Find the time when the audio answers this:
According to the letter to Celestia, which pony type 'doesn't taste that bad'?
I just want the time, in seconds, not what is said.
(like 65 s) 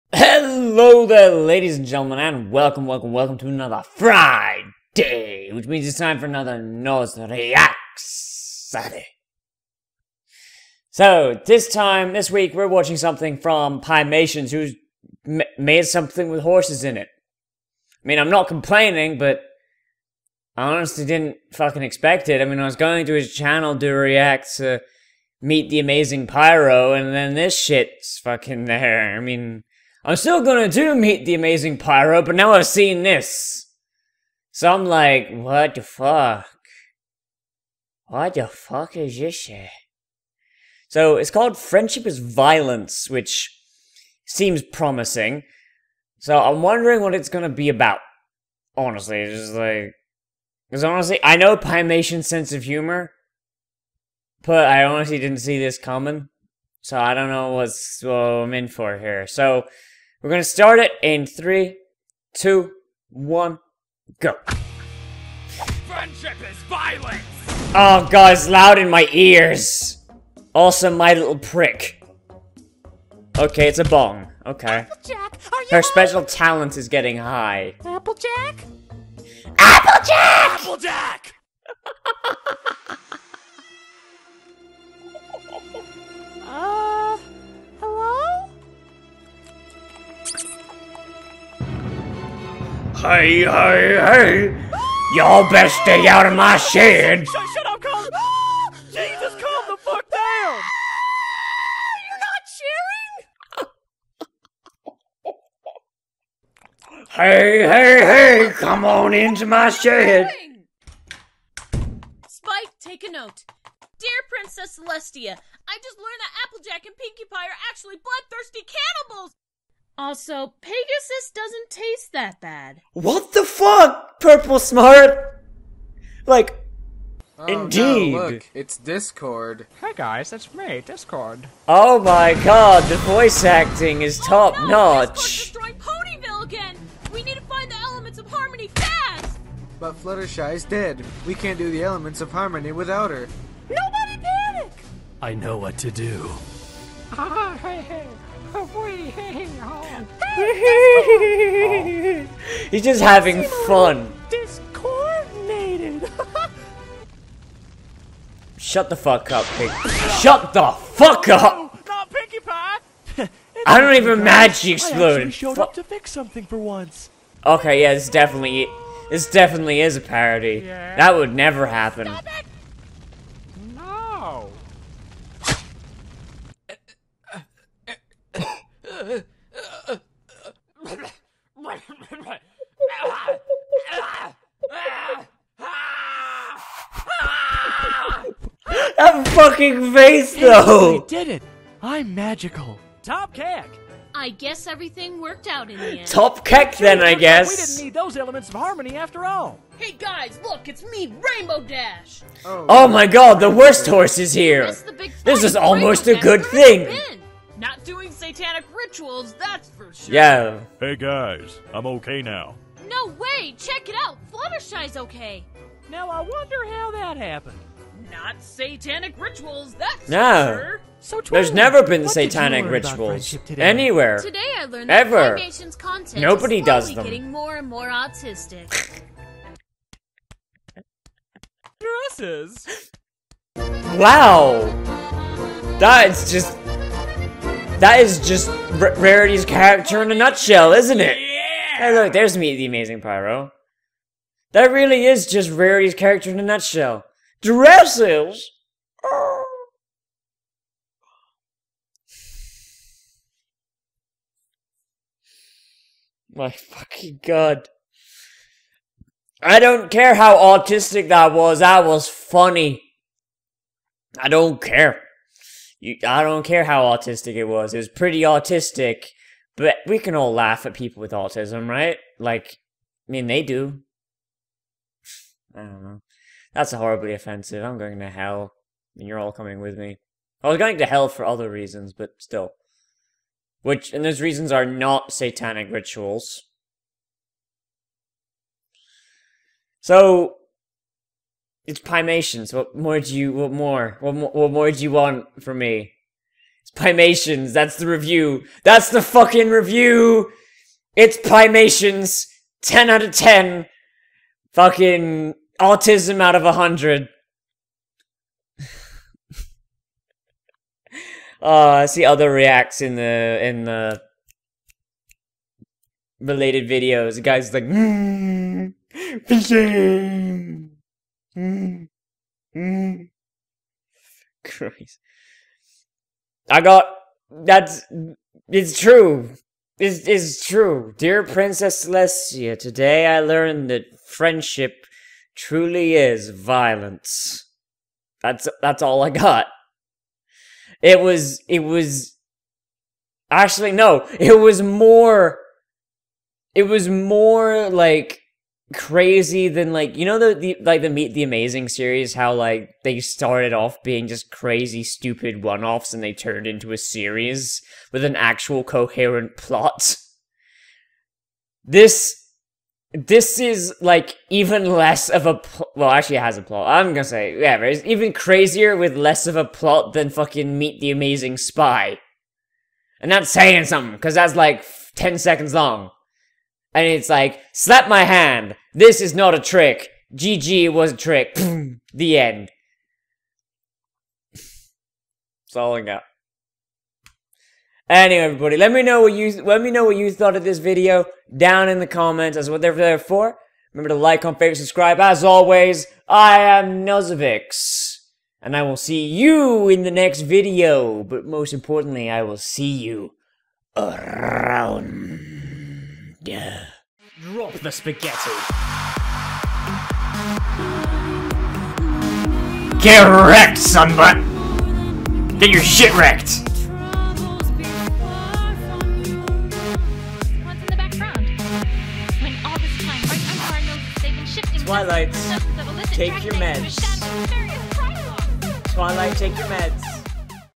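120 s.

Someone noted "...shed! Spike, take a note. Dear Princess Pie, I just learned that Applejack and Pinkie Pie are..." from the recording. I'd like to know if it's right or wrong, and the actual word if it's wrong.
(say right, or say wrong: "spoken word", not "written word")
wrong: "Celestia", not "Pie".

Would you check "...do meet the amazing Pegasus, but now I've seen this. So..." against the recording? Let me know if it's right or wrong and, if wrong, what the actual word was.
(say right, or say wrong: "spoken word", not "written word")
wrong: "Pyro", not "Pegasus".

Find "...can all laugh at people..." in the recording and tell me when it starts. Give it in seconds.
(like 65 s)
269 s.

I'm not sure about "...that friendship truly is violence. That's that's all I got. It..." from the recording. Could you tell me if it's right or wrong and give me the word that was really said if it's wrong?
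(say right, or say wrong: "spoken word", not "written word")
right.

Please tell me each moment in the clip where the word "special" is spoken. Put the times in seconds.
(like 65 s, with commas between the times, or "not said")
75 s.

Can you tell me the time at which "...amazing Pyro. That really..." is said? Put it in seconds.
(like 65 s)
242 s.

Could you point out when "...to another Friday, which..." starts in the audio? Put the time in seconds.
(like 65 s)
3 s.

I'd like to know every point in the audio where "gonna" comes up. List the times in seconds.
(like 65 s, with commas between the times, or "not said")
30 s, 47 s, 60 s, 366 s.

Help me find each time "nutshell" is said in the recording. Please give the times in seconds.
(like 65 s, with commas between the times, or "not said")
240 s, 246 s.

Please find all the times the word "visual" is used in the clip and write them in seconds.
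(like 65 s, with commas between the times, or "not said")
not said.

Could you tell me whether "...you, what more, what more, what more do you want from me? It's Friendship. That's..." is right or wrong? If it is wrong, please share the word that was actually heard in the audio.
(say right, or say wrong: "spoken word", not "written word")
wrong: "Piemations", not "Friendship".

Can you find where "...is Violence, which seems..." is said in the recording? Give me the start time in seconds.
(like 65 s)
42 s.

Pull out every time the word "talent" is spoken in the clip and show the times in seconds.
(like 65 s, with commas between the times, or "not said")
76 s.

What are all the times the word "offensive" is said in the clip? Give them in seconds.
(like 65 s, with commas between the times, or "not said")
277 s.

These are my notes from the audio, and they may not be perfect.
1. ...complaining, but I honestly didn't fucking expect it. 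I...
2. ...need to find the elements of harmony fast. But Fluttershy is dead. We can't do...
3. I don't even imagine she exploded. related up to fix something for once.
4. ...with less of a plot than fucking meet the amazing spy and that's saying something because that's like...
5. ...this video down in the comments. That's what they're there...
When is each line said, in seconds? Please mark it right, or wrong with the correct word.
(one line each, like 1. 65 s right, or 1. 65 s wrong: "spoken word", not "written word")
1. 18 s right
2. 137 s right
3. 163 s wrong: "showed", not "related"
4. 368 s right
5. 390 s right.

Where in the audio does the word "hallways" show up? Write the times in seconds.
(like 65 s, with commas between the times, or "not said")
not said.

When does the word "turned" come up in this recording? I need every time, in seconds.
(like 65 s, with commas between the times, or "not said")
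356 s.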